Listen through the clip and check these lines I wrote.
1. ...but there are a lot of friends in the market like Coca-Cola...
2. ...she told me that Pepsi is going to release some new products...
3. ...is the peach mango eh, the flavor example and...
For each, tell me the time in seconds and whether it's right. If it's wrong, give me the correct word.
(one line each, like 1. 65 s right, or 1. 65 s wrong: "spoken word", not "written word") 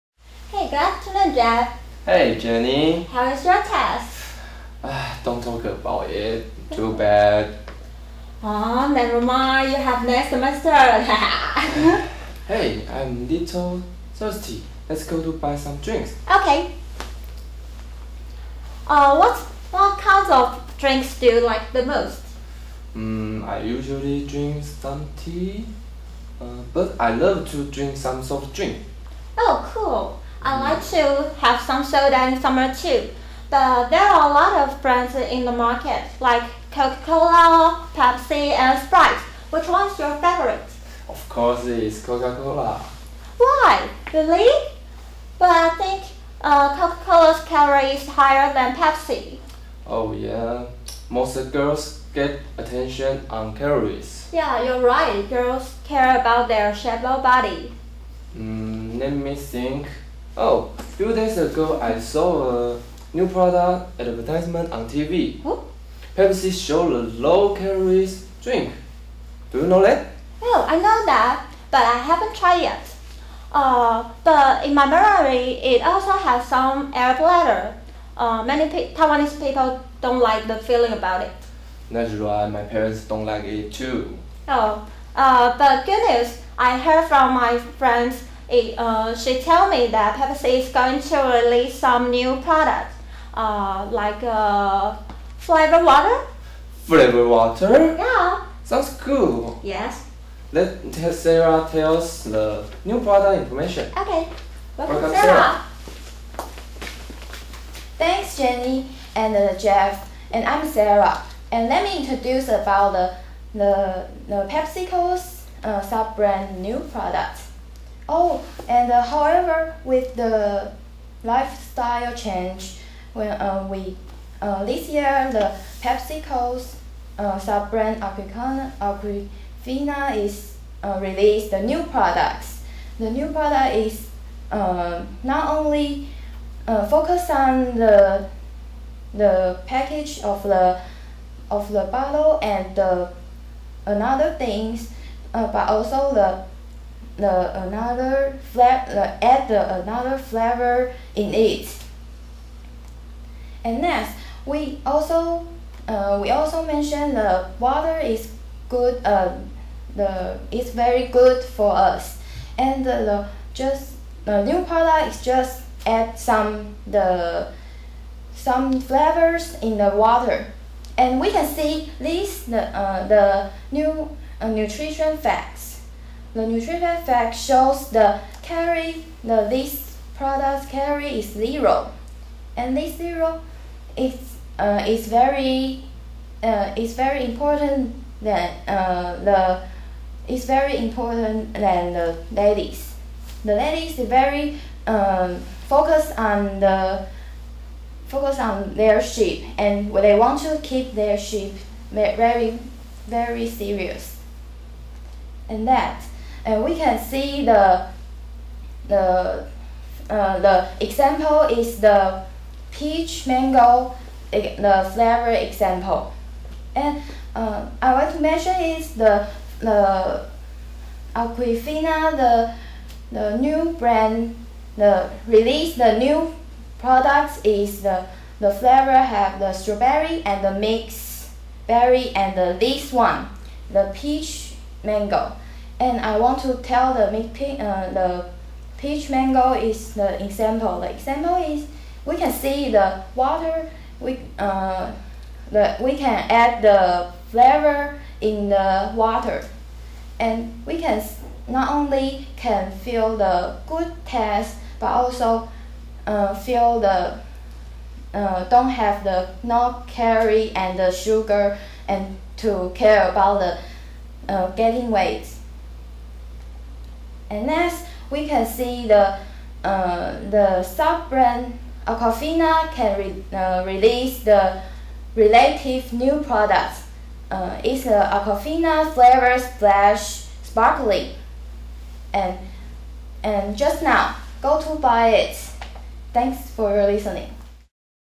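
1. 33 s wrong: "brands", not "friends"
2. 89 s right
3. 211 s right.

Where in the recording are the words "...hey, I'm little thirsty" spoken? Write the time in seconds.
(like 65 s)
12 s.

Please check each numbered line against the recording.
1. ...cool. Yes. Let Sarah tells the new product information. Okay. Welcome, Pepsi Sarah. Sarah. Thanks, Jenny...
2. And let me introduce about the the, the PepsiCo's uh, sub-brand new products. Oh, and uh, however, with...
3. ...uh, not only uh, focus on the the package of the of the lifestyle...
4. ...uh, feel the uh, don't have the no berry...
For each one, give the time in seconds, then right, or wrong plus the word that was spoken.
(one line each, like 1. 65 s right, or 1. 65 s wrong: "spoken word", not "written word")
1. 98 s wrong: "Welcome", not "Pepsi"
2. 111 s right
3. 134 s wrong: "bottle", not "lifestyle"
4. 256 s wrong: "carry", not "berry".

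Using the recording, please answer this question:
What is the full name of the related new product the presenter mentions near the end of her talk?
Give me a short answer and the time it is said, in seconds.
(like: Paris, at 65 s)
Aquafina Flavor Splash Sparkling, at 278 s.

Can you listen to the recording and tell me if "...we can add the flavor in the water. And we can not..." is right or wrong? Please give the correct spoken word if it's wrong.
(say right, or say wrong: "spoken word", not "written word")
right.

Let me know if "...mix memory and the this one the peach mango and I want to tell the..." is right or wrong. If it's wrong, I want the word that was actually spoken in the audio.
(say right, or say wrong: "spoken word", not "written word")
wrong: "berry", not "memory".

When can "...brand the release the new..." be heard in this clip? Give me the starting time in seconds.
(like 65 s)
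223 s.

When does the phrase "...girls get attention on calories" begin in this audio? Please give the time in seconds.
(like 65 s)
51 s.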